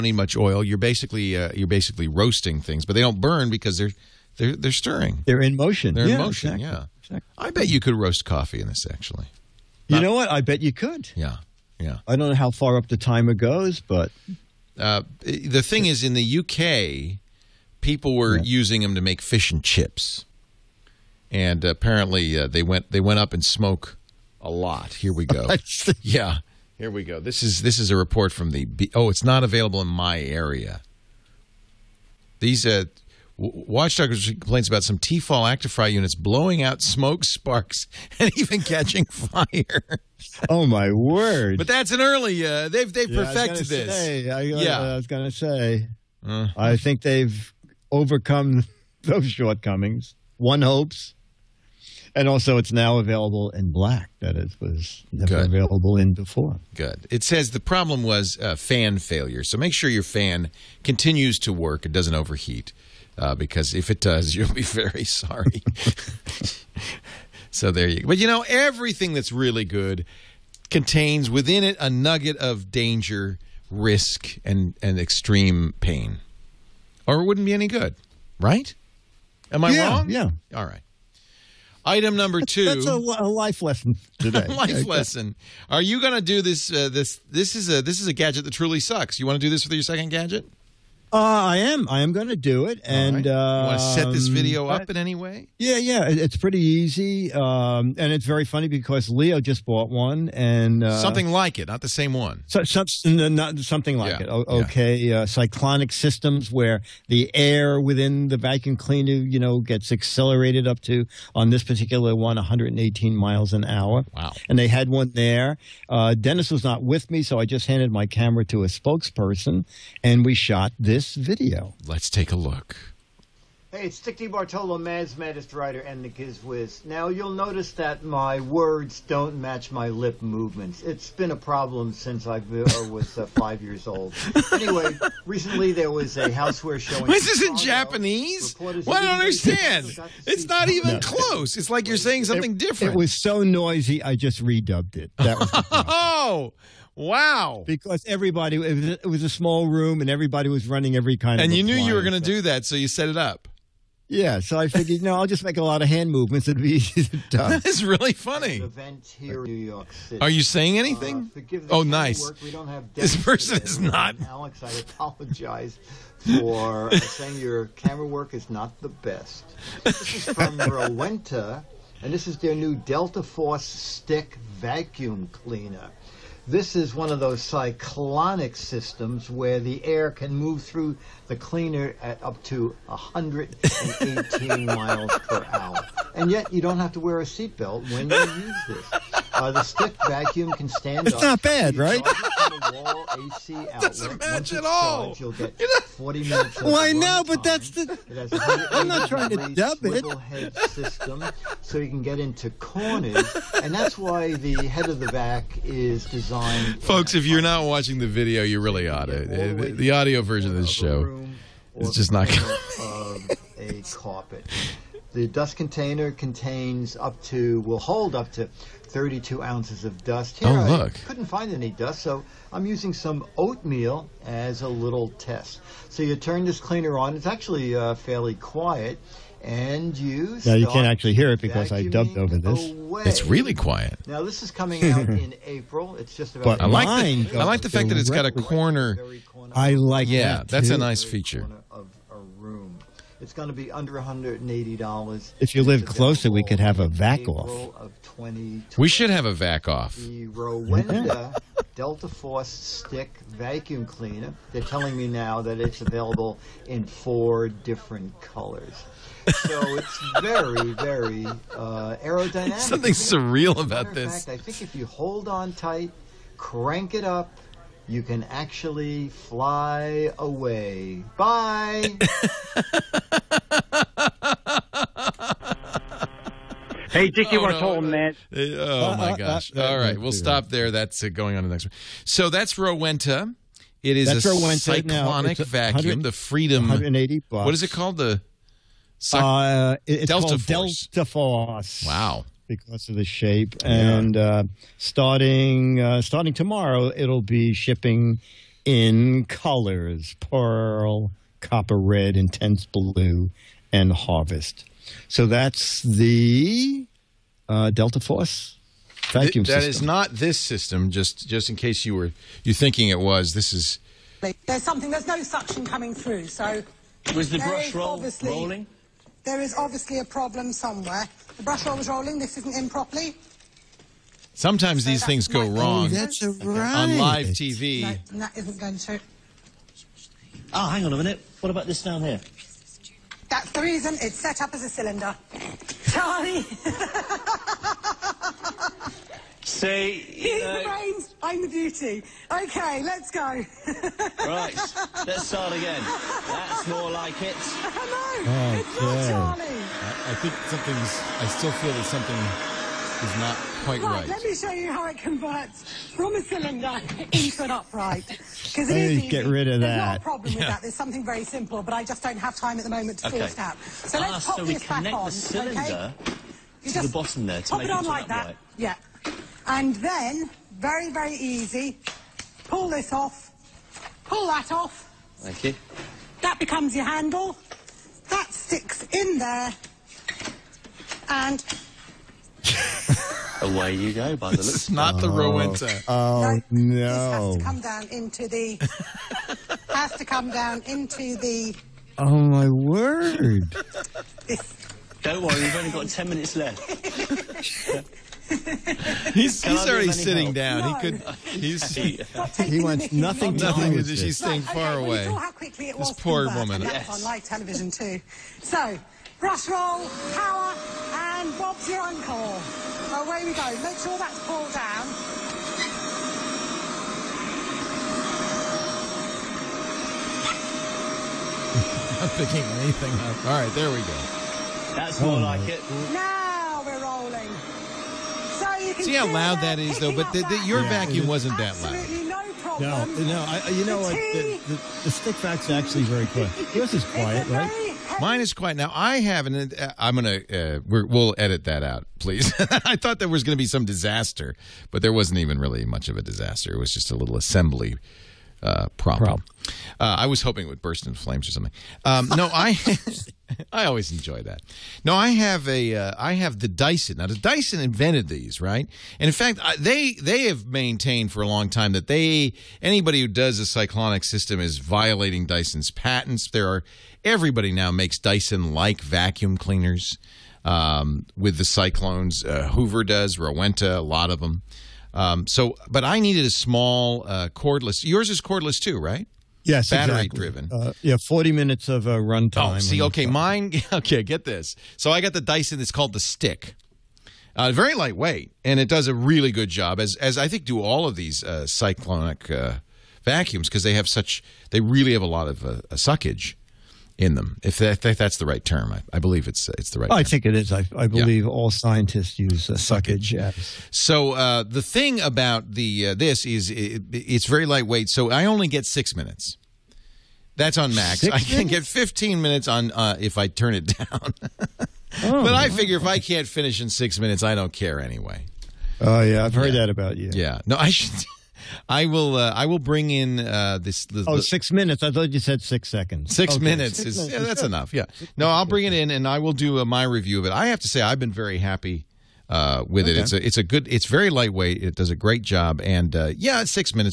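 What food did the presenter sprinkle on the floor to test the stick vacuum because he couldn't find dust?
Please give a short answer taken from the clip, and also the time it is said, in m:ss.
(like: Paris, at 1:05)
oatmeal, at 3:43.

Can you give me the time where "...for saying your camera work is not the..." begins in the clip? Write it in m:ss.
2:46.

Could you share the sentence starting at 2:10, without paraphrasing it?
It's been a problem since I uh, was uh, five years old.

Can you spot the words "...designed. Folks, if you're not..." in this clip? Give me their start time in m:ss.
3:26.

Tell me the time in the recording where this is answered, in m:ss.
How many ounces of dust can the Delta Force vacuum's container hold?
3:38.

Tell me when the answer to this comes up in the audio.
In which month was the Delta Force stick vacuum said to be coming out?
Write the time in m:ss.
3:55.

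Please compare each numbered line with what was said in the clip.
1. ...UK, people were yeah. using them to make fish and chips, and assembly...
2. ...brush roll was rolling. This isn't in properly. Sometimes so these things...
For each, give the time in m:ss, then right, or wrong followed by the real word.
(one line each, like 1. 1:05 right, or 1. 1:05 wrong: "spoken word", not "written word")
1. 0:16 wrong: "apparently", not "assembly"
2. 5:21 right.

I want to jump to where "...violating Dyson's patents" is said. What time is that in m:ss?
7:44.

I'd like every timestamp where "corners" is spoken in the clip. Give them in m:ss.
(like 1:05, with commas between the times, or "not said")
3:22, 3:58.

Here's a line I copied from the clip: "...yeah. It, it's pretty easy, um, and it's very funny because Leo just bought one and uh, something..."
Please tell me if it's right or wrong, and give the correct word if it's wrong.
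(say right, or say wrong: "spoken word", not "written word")
right.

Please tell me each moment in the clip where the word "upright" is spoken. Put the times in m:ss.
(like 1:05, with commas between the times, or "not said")
5:57, 6:08.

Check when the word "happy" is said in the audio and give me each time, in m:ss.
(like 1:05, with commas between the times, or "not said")
8:51.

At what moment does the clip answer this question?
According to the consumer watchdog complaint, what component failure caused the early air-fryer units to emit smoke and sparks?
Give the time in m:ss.
0:58.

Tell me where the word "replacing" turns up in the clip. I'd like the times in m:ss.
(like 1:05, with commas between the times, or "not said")
not said.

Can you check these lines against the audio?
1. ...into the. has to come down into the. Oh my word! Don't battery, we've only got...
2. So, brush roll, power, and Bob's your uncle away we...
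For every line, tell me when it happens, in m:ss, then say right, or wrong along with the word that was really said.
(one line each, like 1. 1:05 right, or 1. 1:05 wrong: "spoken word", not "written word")
1. 6:27 wrong: "worry", not "battery"
2. 6:48 right.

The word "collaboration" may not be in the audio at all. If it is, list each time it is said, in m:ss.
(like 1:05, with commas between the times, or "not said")
not said.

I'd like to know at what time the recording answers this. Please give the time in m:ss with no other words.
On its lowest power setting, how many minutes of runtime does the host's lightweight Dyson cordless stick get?
8:31.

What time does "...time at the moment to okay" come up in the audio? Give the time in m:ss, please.
6:02.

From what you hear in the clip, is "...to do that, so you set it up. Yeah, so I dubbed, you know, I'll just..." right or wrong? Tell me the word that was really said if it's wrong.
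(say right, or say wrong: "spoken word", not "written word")
wrong: "figured", not "dubbed".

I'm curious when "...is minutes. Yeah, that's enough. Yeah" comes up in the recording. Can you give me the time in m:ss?
8:46.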